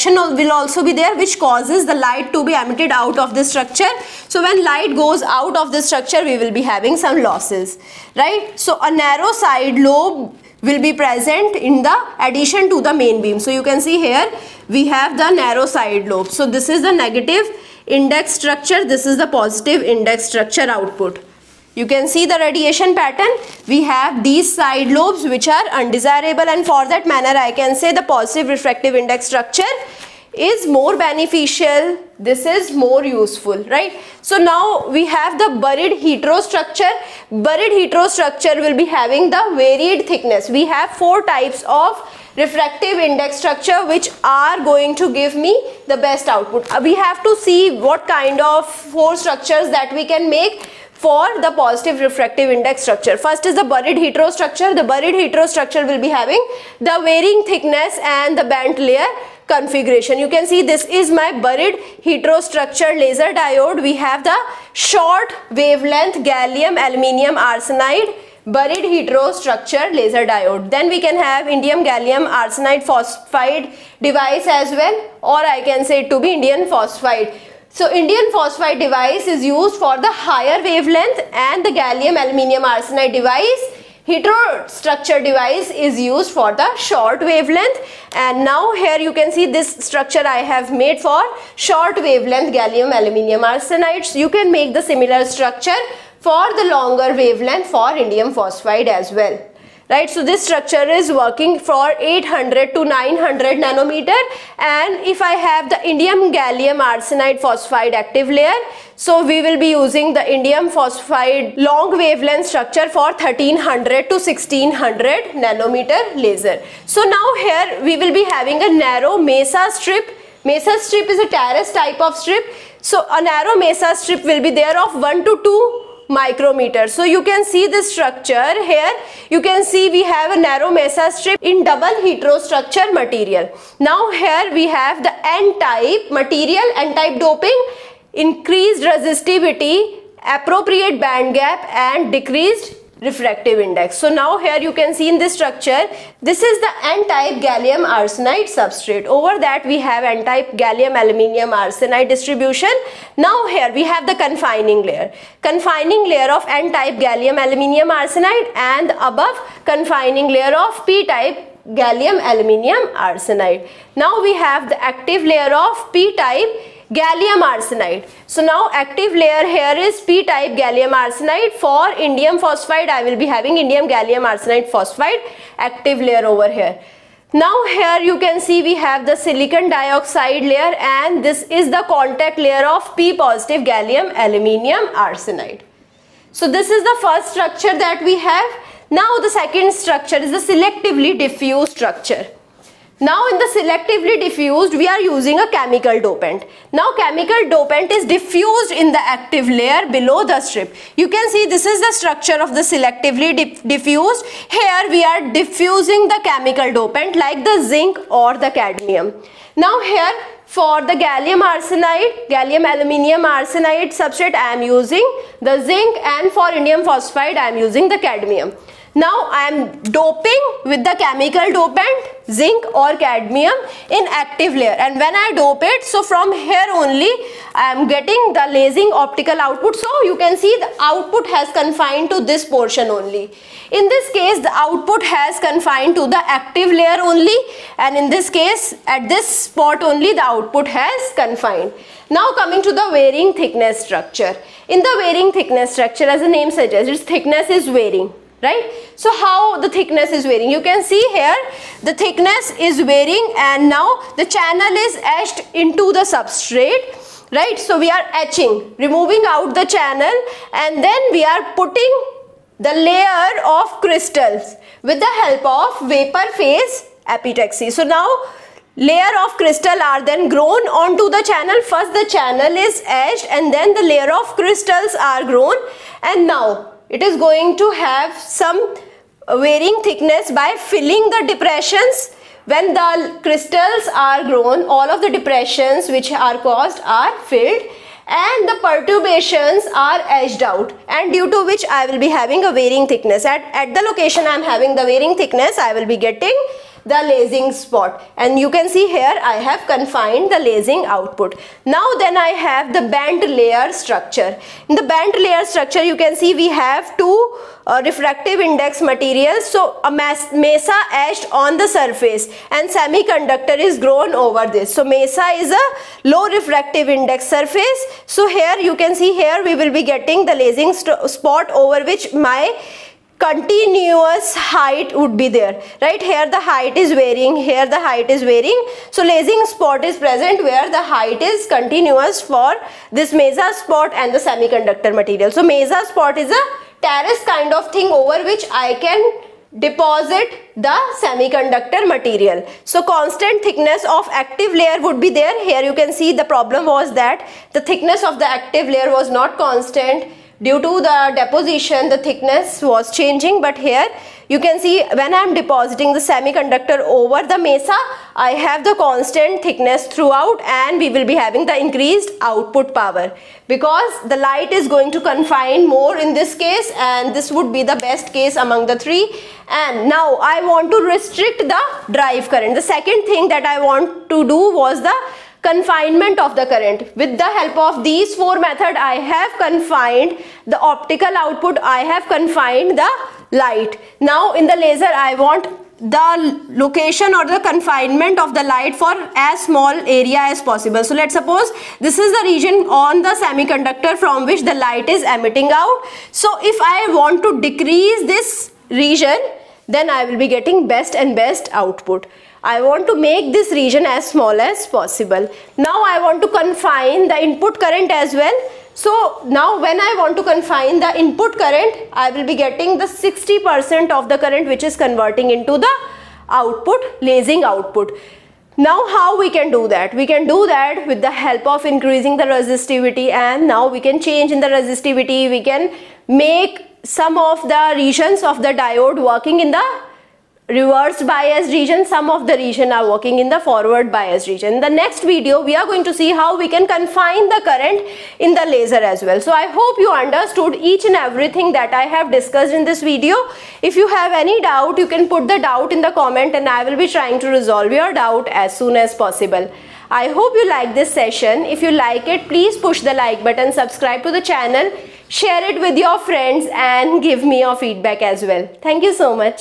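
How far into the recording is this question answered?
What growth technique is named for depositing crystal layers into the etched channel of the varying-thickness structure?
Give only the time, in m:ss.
4:25.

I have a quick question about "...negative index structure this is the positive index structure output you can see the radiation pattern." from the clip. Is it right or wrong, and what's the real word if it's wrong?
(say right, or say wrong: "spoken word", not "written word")
right.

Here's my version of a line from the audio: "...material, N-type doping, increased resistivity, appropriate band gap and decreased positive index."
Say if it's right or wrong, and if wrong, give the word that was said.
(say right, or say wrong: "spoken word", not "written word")
wrong: "refractive", not "positive".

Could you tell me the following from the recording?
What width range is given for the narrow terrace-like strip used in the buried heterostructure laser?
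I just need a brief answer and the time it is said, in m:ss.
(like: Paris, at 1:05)
1 to 2 micrometer, at 2:05.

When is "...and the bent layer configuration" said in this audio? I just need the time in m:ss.
0:58.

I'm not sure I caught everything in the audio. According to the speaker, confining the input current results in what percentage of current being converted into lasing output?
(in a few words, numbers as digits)
60%.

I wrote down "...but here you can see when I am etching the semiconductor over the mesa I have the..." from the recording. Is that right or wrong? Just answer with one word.
wrong.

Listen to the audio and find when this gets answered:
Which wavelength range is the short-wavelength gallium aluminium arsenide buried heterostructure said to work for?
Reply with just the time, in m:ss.
1:42.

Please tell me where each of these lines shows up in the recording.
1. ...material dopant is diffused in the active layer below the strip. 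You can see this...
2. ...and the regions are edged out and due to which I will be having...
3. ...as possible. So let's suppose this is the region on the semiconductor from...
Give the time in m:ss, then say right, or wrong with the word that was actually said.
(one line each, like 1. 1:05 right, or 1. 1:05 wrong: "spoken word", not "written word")
1. 3:16 wrong: "chemical", not "material"
2. 4:48 wrong: "perturbations", not "regions"
3. 6:30 right.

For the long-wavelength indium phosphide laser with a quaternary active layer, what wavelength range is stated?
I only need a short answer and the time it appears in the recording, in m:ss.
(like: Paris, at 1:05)
1300 to 1600 nanometer, at 1:53.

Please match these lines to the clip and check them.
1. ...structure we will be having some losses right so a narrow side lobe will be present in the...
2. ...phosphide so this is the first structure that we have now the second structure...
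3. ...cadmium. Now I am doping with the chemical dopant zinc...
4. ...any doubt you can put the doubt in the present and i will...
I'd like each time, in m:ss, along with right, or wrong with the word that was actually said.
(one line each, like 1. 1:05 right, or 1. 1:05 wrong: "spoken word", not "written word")
1. 0:05 right
2. 3:05 wrong: "arsenide", not "phosphide"
3. 3:37 right
4. 7:24 wrong: "comment", not "present".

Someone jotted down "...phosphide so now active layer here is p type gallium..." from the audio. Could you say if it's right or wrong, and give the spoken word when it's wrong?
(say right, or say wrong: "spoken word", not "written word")
wrong: "arsenide", not "phosphide".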